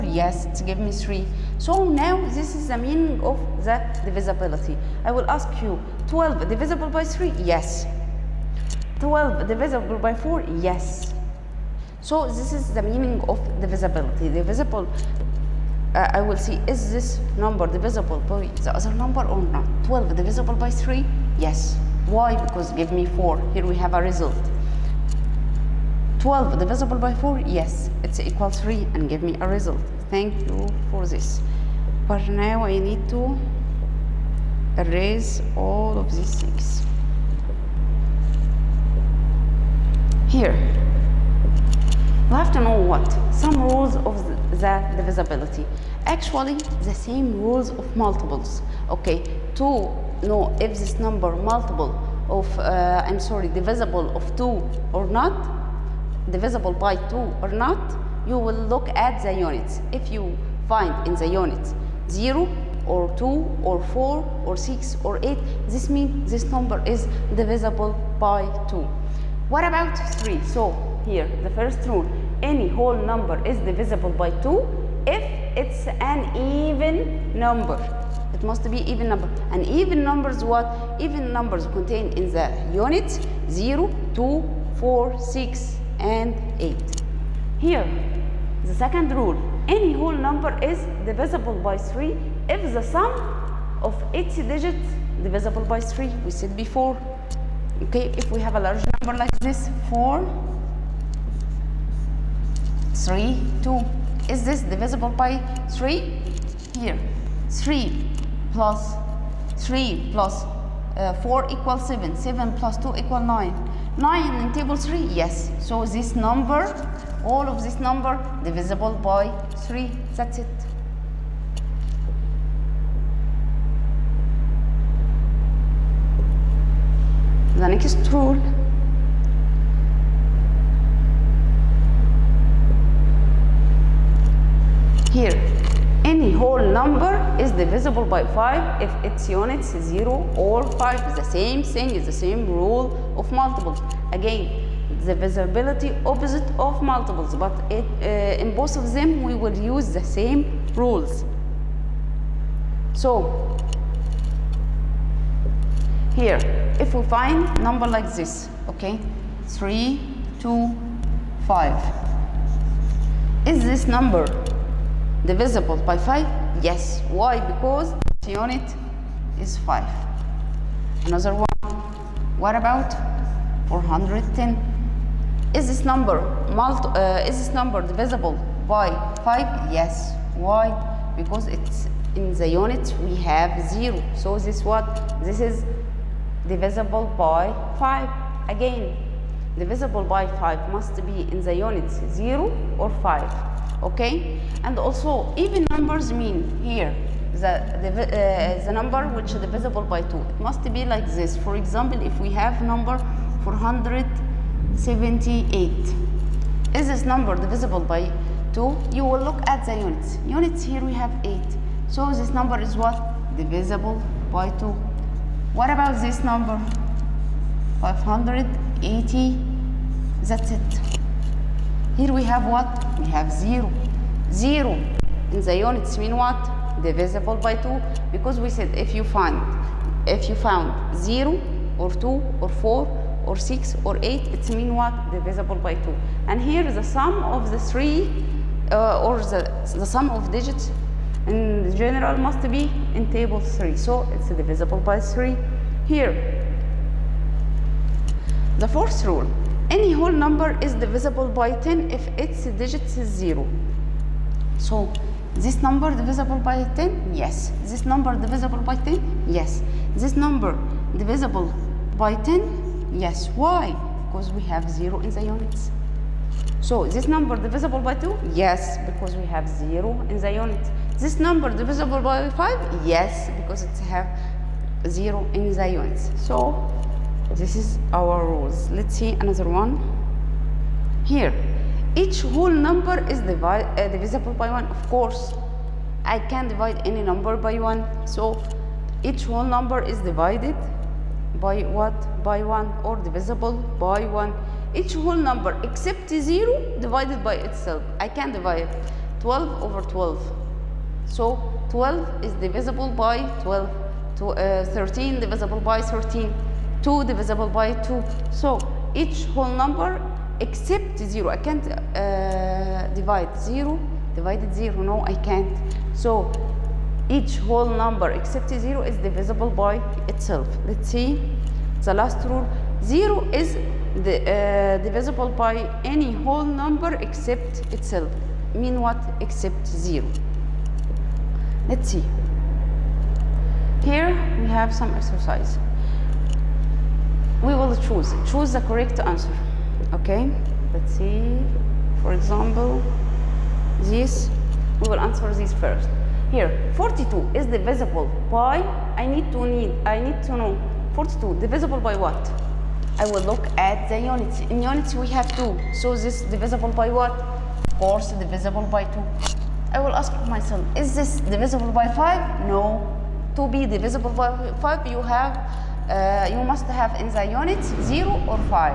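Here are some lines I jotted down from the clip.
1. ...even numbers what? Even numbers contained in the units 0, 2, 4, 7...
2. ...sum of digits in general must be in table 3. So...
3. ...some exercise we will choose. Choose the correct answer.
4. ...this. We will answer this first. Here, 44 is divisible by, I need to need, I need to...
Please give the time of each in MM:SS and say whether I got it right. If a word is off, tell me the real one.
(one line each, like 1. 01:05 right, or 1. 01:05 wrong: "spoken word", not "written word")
1. 01:19 wrong: "6", not "7"
2. 03:59 right
3. 05:34 right
4. 05:43 wrong: "42", not "44".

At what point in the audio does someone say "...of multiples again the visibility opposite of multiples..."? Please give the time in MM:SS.
02:23.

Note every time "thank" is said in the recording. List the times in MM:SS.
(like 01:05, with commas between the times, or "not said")
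00:30.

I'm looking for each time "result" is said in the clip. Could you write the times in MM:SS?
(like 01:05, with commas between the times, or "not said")
00:24, 00:29.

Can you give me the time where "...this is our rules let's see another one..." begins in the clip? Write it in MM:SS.
04:37.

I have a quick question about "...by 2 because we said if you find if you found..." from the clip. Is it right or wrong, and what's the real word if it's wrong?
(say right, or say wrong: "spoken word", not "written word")
right.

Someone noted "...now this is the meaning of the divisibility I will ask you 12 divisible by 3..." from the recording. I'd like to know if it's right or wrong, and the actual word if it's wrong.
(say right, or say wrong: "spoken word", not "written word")
right.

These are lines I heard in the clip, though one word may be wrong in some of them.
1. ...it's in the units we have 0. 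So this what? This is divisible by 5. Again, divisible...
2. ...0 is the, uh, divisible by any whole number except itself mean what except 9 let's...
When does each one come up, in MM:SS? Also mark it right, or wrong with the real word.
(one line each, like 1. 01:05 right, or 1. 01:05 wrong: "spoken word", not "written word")
1. 03:01 right
2. 05:22 wrong: "0", not "9".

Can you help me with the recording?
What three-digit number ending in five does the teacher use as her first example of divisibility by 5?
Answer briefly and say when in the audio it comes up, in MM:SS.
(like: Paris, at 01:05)
325, at 02:39.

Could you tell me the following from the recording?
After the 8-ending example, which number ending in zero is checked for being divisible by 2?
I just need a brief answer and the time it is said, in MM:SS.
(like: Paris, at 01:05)
580, at 03:37.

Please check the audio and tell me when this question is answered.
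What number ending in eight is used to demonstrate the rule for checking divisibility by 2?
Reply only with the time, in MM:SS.
03:23.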